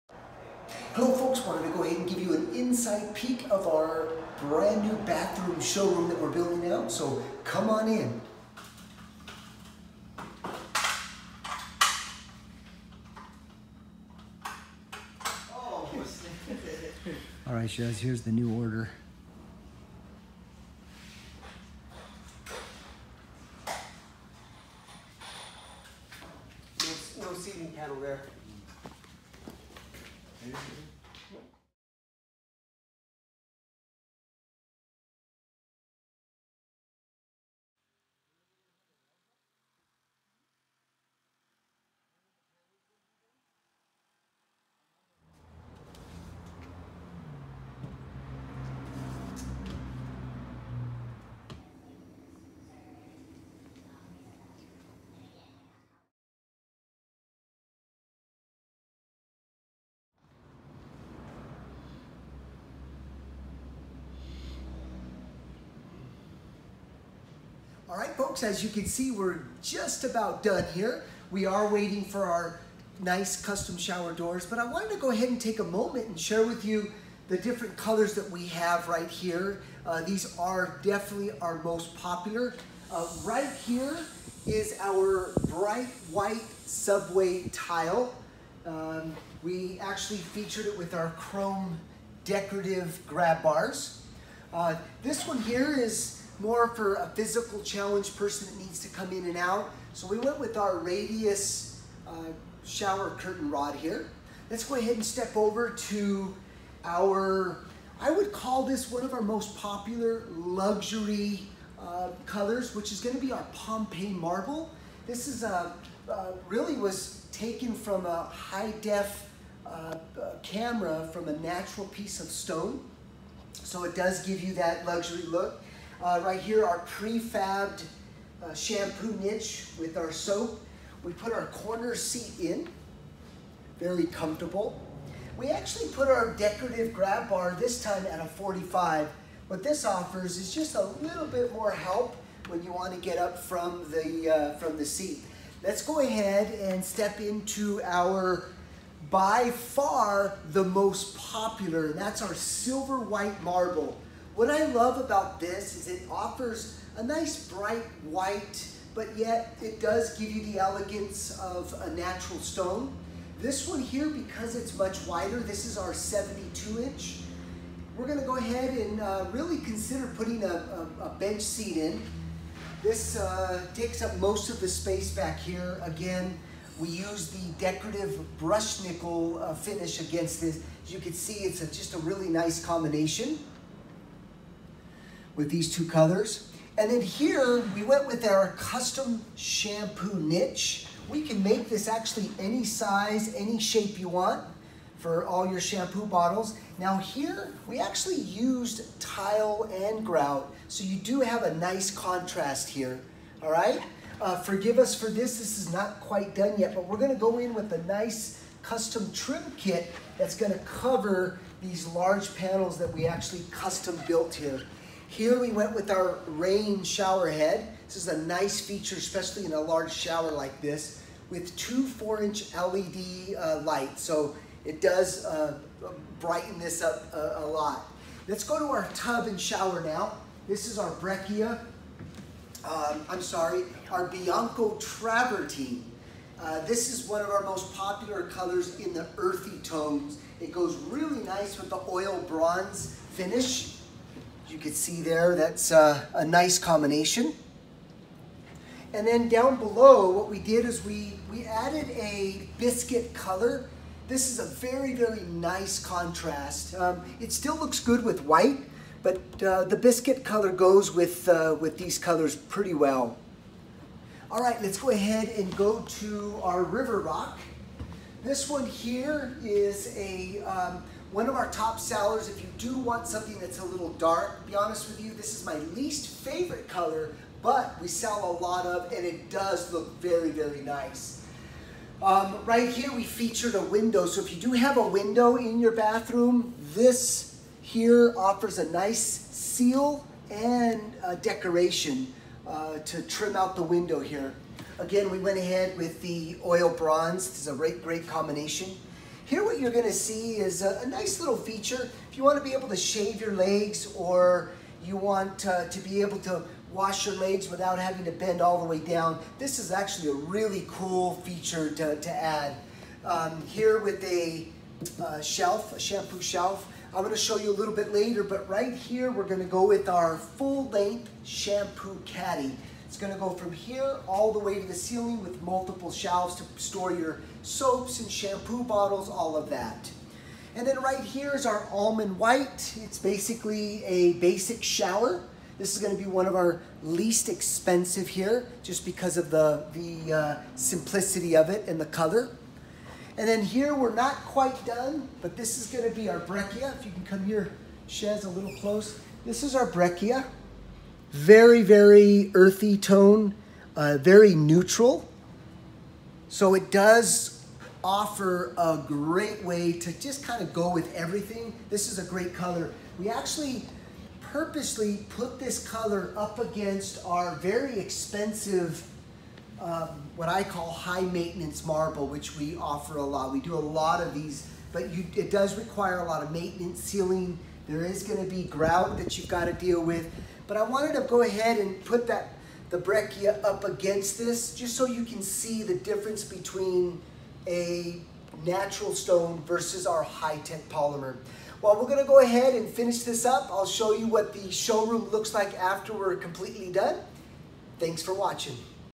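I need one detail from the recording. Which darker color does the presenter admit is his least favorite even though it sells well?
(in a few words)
river rock.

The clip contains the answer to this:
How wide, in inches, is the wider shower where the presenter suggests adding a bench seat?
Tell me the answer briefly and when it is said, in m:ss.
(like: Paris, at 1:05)
72, at 2:45.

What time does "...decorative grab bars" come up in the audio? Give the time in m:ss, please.
1:32.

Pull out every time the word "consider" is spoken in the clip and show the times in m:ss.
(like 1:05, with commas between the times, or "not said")
2:49.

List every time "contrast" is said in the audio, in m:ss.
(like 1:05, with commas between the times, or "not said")
3:21, 4:15.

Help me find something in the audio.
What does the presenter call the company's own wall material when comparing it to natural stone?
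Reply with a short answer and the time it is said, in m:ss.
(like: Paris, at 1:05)
high-tech polymer, at 6:30.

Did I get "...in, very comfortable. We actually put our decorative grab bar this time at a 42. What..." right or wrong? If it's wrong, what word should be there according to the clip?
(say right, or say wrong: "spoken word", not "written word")
wrong: "45", not "42".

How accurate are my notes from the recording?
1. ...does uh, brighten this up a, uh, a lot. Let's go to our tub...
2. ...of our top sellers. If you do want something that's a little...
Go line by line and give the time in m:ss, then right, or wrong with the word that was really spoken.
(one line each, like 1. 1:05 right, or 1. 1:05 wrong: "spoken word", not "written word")
1. 3:44 right
2. 4:31 right.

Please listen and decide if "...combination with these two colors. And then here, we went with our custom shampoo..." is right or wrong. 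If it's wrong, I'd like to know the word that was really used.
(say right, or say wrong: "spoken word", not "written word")
right.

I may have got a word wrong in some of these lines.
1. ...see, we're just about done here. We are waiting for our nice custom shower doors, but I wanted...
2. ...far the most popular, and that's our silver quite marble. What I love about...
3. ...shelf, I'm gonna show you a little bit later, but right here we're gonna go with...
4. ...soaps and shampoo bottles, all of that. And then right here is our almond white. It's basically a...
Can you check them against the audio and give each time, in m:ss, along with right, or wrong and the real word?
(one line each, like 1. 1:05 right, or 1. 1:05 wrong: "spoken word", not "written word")
1. 1:08 right
2. 2:29 wrong: "white", not "quite"
3. 5:16 right
4. 5:27 right.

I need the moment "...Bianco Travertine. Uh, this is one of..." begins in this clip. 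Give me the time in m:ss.
3:54.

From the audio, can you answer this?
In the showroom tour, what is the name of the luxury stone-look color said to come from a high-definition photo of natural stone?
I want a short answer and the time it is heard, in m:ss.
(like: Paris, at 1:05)
Pompeii marble, at 1:53.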